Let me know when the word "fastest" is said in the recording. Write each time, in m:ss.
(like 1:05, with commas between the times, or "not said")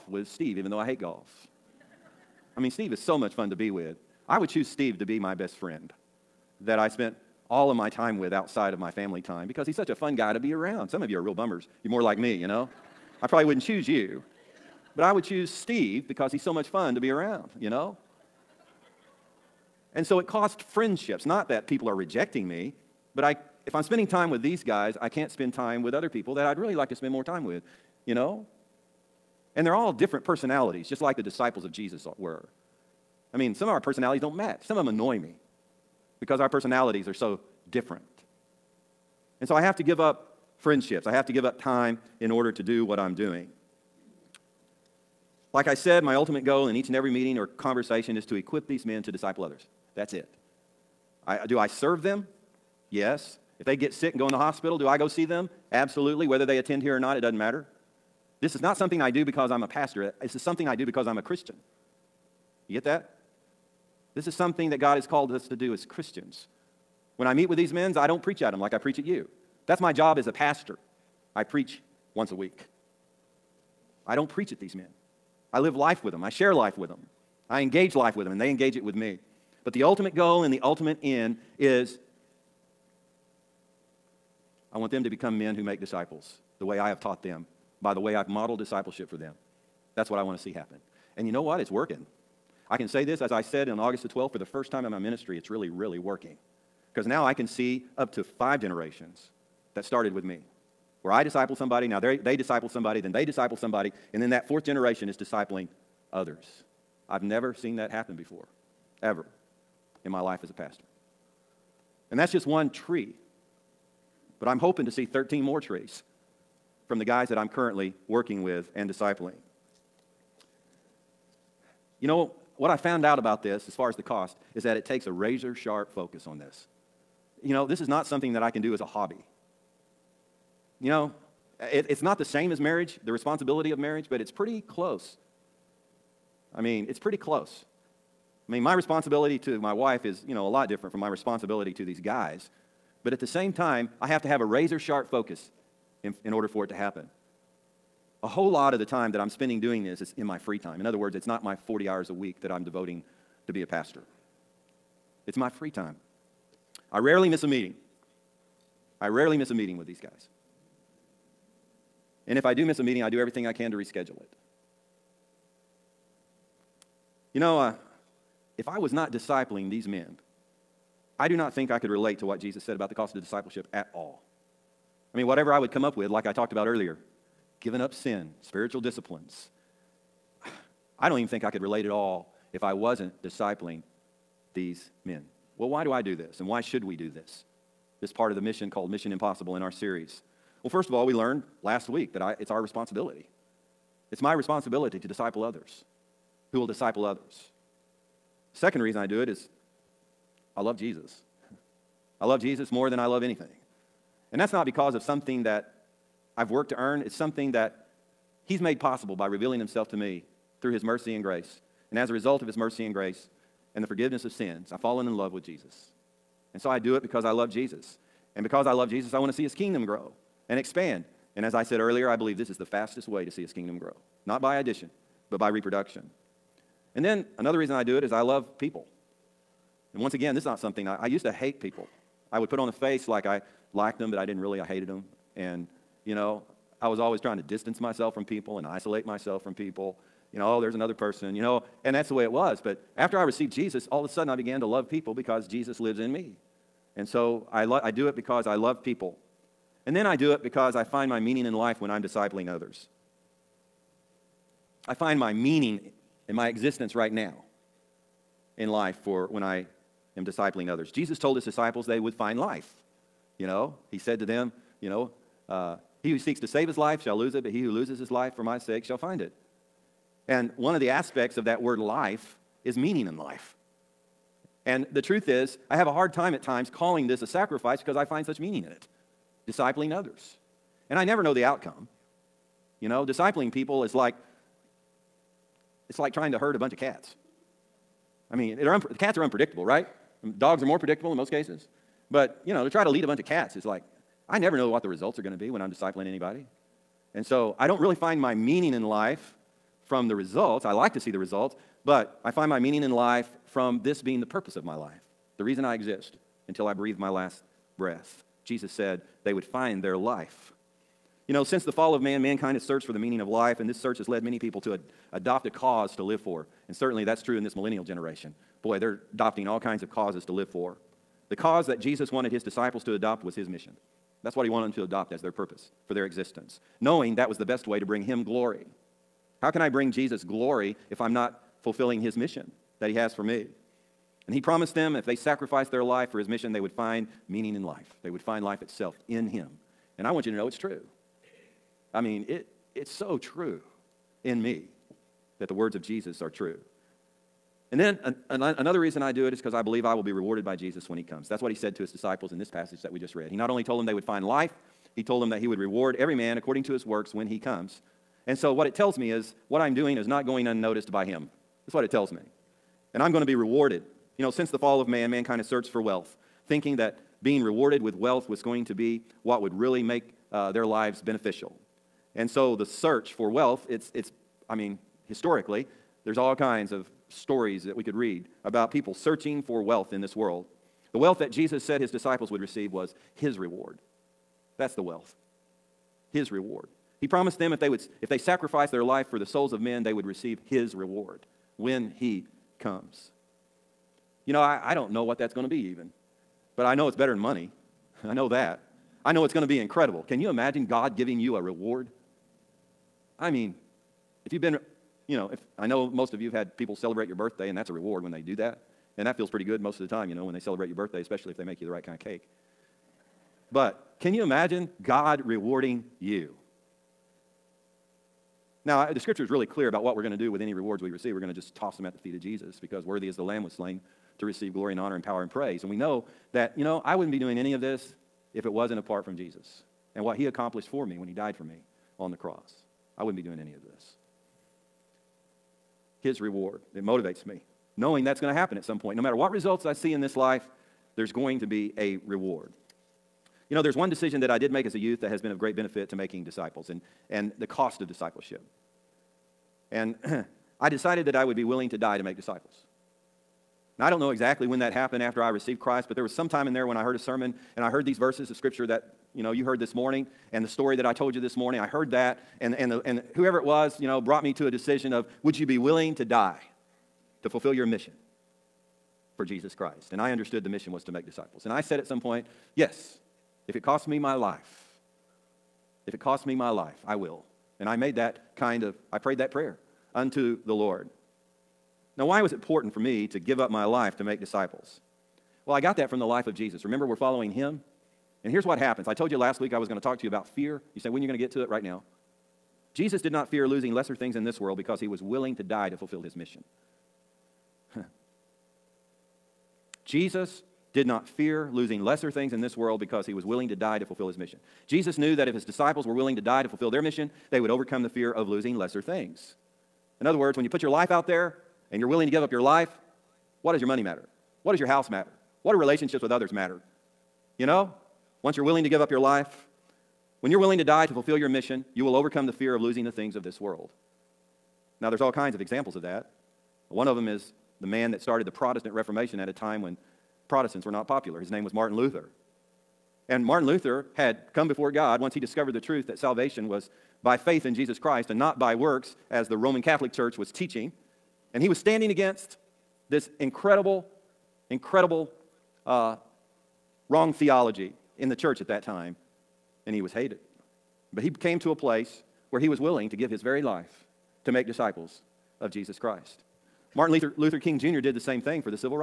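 3:42.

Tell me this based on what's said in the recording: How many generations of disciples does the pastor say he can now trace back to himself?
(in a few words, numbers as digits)
5.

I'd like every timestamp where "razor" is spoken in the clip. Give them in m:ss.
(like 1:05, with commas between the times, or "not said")
2:05, 2:24.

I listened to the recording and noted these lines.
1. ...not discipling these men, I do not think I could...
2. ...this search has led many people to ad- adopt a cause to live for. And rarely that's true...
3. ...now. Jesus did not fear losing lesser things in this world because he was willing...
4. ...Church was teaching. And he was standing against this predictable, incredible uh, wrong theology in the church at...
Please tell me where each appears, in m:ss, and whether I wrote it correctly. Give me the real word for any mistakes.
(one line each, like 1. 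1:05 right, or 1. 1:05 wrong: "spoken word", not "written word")
1. 2:48 right
2. 5:13 wrong: "certainly", not "rarely"
3. 8:11 right
4. 8:59 wrong: "incredible", not "predictable".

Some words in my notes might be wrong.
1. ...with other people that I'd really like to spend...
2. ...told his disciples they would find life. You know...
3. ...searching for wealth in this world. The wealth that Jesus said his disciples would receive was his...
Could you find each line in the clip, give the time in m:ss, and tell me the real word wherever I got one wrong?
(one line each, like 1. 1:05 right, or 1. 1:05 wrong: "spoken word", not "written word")
1. 0:25 right
2. 4:21 right
3. 6:18 right.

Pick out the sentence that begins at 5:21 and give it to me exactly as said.
The cause that Jesus wanted his disciples to adopt was his mission.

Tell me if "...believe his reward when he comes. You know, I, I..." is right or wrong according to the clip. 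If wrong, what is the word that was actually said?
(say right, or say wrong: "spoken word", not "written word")
wrong: "receive", not "believe".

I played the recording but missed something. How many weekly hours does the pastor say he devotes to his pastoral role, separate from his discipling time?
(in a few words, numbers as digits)
40.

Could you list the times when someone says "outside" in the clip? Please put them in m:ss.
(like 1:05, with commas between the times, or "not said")
0:08.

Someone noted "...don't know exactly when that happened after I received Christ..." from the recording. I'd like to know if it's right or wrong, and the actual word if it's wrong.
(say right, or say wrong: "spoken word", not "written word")
right.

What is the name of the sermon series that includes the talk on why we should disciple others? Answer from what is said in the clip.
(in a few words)
Mission Impossible.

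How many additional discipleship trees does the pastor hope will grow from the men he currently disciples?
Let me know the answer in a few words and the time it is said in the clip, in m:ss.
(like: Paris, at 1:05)
13, at 1:55.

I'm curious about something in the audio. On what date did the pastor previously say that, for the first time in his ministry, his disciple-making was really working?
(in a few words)
August 12.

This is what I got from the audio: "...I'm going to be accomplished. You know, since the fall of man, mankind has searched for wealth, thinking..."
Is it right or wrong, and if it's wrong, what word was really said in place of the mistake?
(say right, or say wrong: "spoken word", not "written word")
wrong: "rewarded", not "accomplished".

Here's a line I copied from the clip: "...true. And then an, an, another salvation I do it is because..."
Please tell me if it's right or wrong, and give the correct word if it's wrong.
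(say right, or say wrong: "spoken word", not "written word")
wrong: "reason", not "salvation".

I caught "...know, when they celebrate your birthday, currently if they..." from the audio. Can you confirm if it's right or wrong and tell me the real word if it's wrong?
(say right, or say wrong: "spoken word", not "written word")
wrong: "especially", not "currently".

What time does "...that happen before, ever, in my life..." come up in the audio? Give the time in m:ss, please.
1:47.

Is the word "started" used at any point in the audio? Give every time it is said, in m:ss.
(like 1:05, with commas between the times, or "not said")
1:39, 8:47.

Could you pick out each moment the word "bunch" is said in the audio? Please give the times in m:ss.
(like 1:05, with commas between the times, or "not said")
4:46, 4:53.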